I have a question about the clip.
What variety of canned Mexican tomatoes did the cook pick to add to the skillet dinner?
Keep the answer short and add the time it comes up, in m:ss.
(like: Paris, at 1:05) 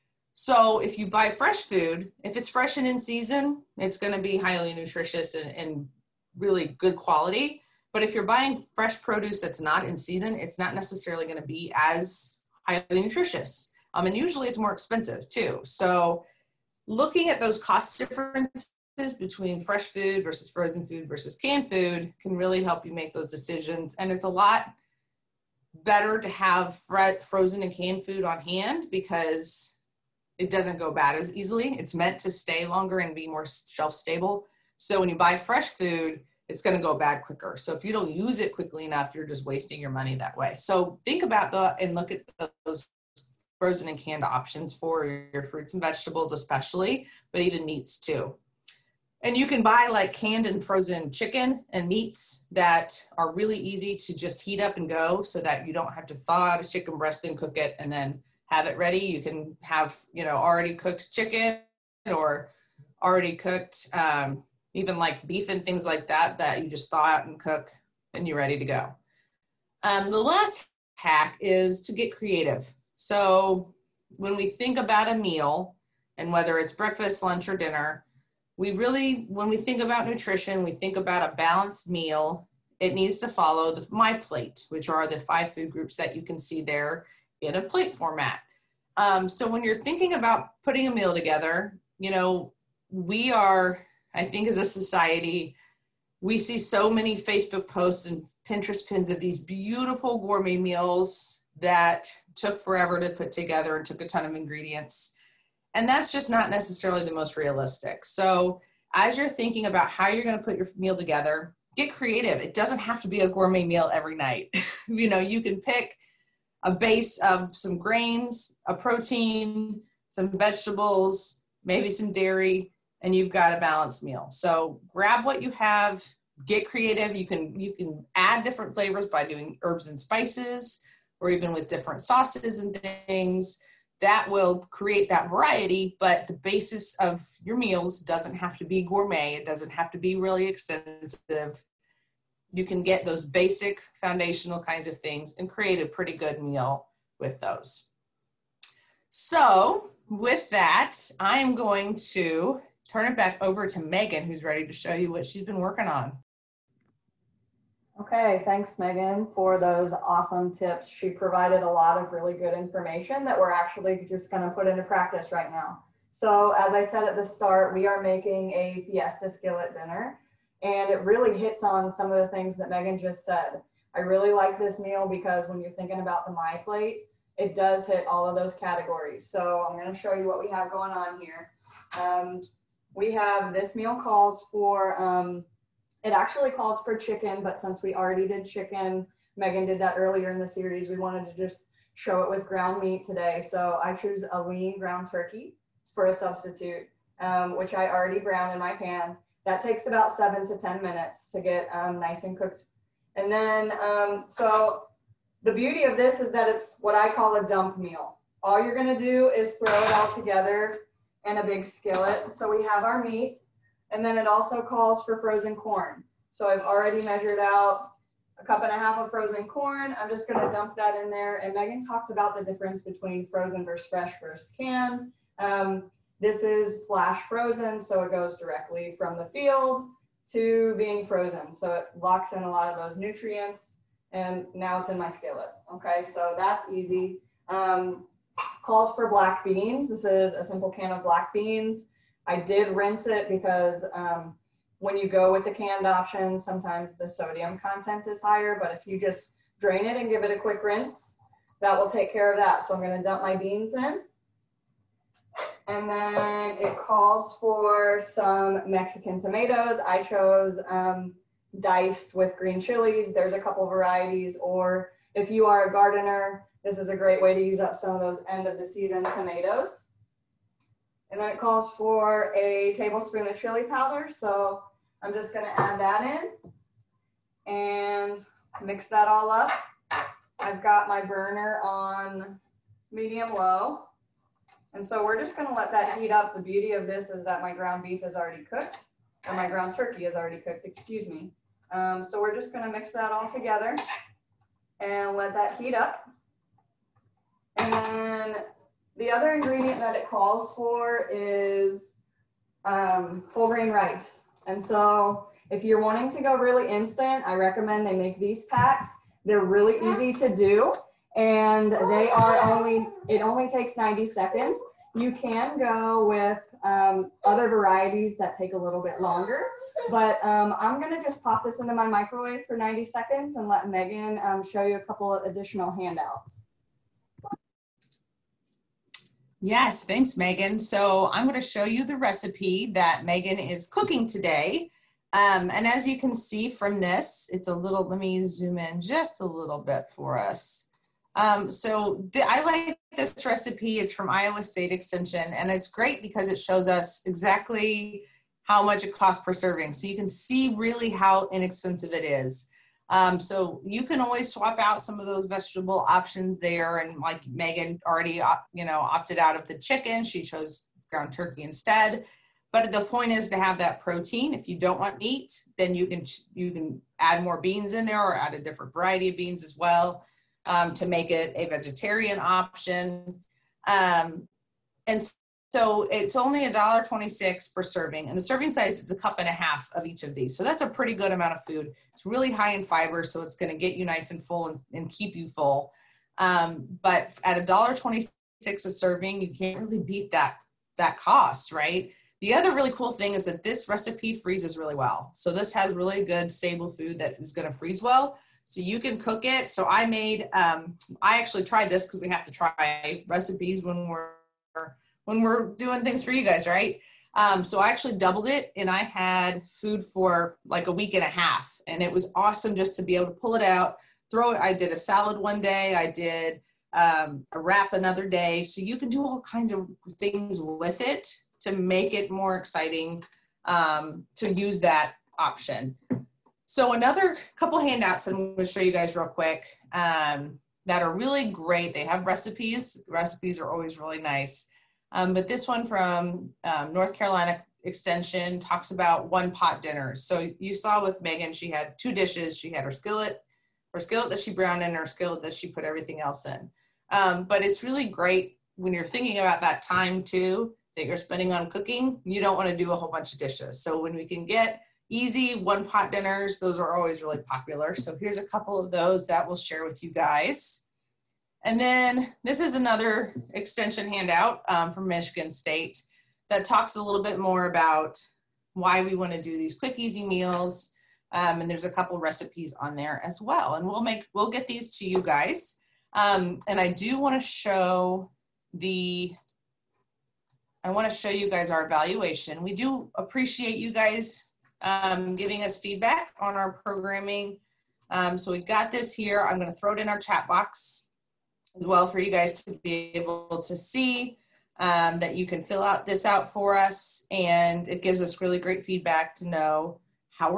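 diced with green chilies, at 4:21.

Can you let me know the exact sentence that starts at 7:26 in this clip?
Um, but it's really great when you're thinking about that time too that you're spending on cooking.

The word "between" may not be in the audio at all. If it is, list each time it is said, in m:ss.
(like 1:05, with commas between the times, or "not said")
0:19, 3:42.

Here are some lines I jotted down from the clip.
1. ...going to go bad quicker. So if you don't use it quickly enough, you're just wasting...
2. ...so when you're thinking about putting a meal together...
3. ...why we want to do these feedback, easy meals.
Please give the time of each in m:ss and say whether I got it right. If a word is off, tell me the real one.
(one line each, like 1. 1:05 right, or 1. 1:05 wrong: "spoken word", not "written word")
1. 0:36 right
2. 1:29 right
3. 7:48 wrong: "quick", not "feedback".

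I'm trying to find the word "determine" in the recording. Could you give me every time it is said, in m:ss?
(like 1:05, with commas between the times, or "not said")
not said.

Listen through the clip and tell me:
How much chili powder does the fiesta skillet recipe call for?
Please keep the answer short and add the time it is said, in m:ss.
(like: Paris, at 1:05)
a tablespoon, at 4:32.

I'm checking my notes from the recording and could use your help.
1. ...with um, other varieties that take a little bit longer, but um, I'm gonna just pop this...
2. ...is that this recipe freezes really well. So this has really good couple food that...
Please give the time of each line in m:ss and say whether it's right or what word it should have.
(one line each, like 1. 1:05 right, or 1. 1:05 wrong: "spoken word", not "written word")
1. 5:16 right
2. 6:33 wrong: "stable", not "couple".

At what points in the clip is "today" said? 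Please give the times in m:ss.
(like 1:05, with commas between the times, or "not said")
3:13, 5:34.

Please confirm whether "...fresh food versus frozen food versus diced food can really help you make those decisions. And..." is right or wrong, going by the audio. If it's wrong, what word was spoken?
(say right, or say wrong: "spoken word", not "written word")
wrong: "canned", not "diced".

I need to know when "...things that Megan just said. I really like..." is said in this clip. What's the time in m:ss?
2:52.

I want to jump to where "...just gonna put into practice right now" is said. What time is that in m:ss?
2:44.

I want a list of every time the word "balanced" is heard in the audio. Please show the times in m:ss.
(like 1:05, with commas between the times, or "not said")
1:21, 2:03.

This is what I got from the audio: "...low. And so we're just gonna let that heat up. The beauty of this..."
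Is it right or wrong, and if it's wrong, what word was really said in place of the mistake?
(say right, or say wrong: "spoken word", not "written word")
right.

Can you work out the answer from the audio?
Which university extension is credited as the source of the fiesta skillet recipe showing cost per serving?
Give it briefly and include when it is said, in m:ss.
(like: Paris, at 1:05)
Iowa State Extension, at 5:44.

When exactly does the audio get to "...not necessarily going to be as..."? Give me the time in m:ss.
0:10.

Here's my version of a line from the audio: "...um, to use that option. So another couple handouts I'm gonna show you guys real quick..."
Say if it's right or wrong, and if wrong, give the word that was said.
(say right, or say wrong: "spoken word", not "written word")
right.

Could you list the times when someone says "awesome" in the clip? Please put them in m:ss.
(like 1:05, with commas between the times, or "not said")
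2:39, 6:52.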